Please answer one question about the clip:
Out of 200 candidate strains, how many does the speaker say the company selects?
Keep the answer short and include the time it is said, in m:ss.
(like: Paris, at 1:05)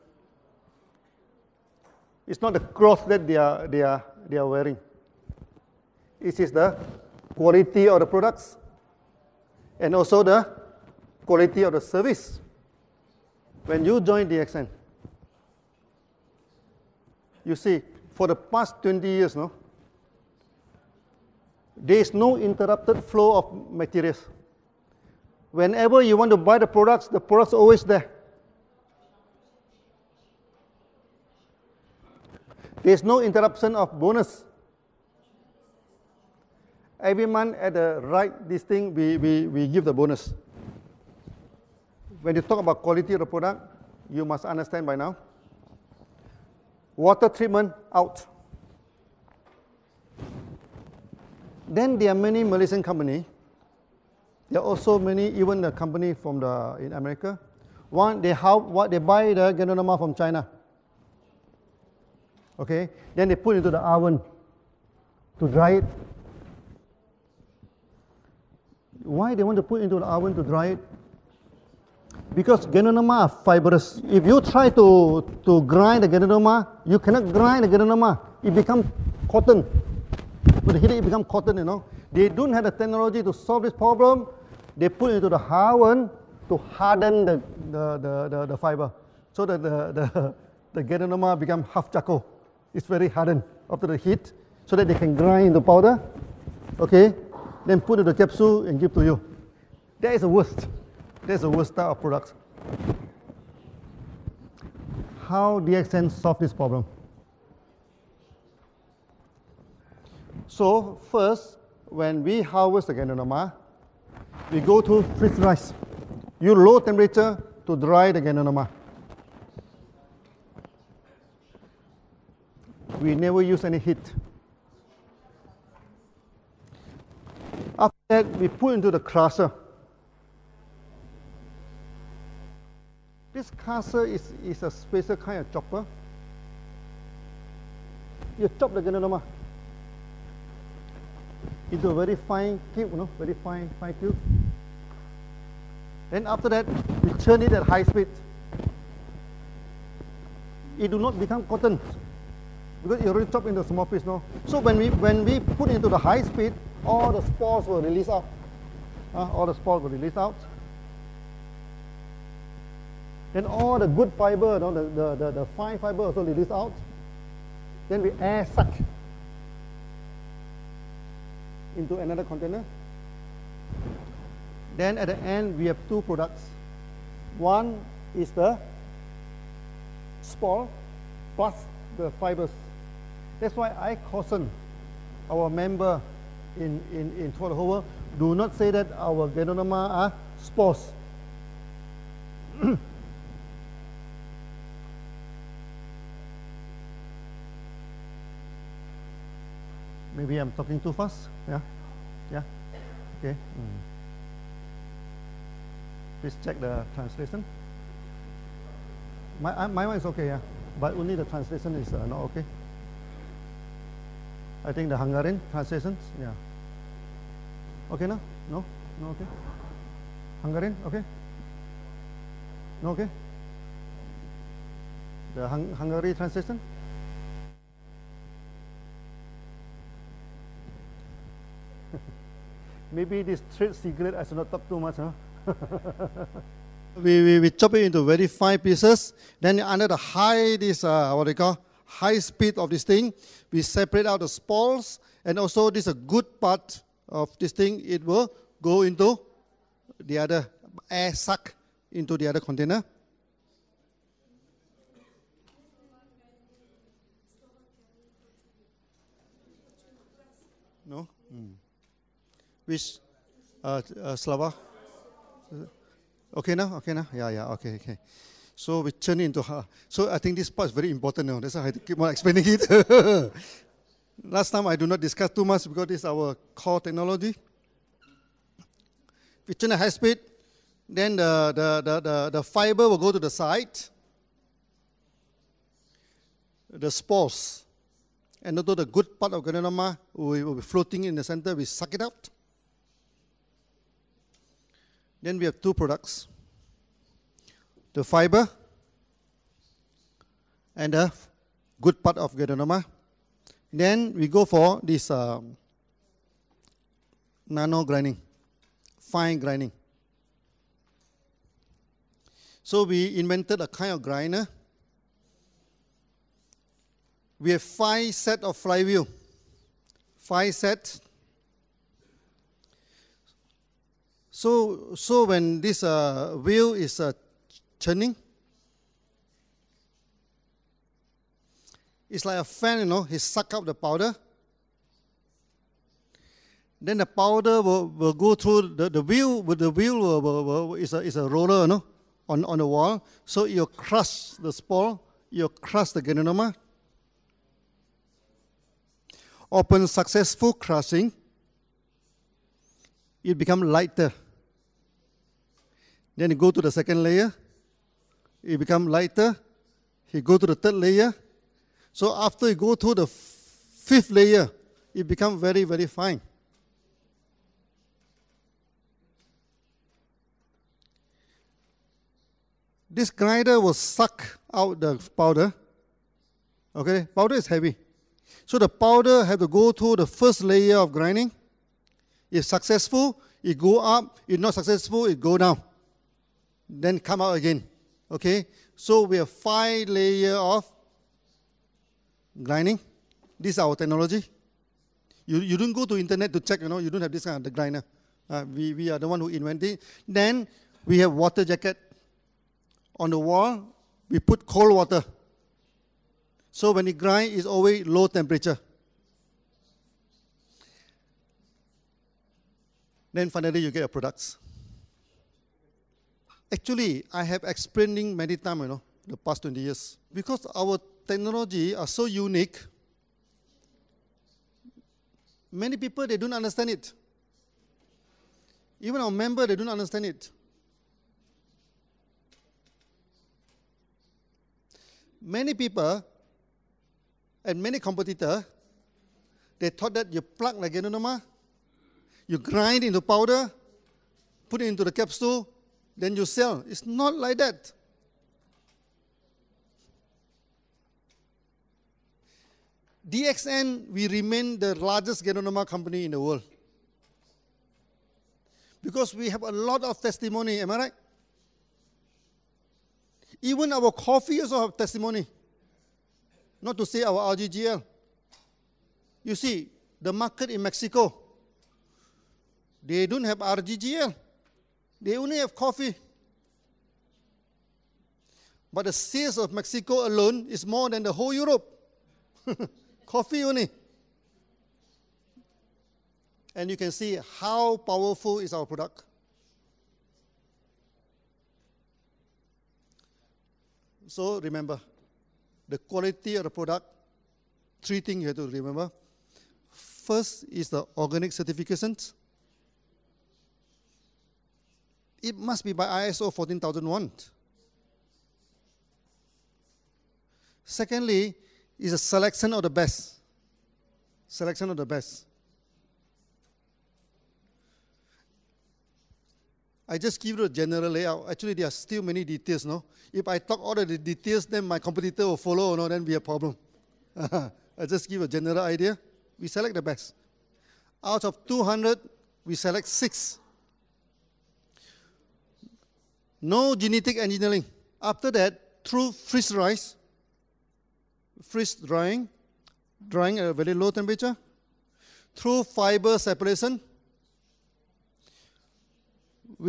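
6, at 8:52.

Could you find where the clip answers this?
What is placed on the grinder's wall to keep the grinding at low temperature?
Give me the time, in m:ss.
6:41.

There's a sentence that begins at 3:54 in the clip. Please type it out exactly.
I should not talk too much.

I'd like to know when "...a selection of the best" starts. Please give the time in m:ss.
8:31.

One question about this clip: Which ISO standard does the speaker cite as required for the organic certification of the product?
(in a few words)
ISO 14001.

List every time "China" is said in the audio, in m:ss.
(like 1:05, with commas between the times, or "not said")
1:00.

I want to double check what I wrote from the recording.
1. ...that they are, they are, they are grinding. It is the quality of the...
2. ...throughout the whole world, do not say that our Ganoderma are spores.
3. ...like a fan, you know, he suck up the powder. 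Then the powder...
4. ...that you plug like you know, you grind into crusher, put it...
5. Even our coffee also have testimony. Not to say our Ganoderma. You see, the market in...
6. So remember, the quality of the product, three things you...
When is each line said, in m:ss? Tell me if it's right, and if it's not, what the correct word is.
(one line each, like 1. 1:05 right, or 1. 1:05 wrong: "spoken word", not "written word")
1. 0:03 wrong: "wearing", not "grinding"
2. 3:07 right
3. 5:32 right
4. 7:19 wrong: "powder", not "crusher"
5. 7:43 wrong: "RGGL", not "Ganoderma"
6. 8:14 right.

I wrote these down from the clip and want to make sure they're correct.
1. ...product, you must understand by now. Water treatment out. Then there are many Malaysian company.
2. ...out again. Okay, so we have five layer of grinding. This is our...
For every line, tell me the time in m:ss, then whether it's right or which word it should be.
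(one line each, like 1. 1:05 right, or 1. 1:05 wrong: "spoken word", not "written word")
1. 0:43 right
2. 6:27 right.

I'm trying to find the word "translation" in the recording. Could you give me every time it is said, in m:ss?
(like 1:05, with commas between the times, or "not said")
3:26, 3:31, 3:35, 3:46.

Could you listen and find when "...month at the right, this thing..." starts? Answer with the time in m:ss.
0:37.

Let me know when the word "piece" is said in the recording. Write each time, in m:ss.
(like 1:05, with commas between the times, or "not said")
2:33, 3:58.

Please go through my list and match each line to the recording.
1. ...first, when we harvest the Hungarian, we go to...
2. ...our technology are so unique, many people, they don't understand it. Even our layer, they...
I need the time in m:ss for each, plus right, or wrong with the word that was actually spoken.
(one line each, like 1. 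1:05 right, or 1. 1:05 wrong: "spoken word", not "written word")
1. 1:51 wrong: "Ganoderma", not "Hungarian"
2. 7:00 wrong: "member", not "layer".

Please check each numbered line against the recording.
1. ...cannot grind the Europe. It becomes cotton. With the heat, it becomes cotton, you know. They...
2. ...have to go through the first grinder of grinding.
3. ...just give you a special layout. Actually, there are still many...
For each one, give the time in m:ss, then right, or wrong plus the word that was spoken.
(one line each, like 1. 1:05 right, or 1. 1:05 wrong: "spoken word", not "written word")
1. 1:16 wrong: "Ganoderma", not "Europe"
2. 6:19 wrong: "layer", not "grinder"
3. 8:39 wrong: "general", not "special".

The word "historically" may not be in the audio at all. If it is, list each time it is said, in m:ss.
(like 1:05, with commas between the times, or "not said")
not said.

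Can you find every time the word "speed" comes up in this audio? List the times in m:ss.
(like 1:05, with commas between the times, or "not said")
2:27, 2:36, 4:02, 4:39.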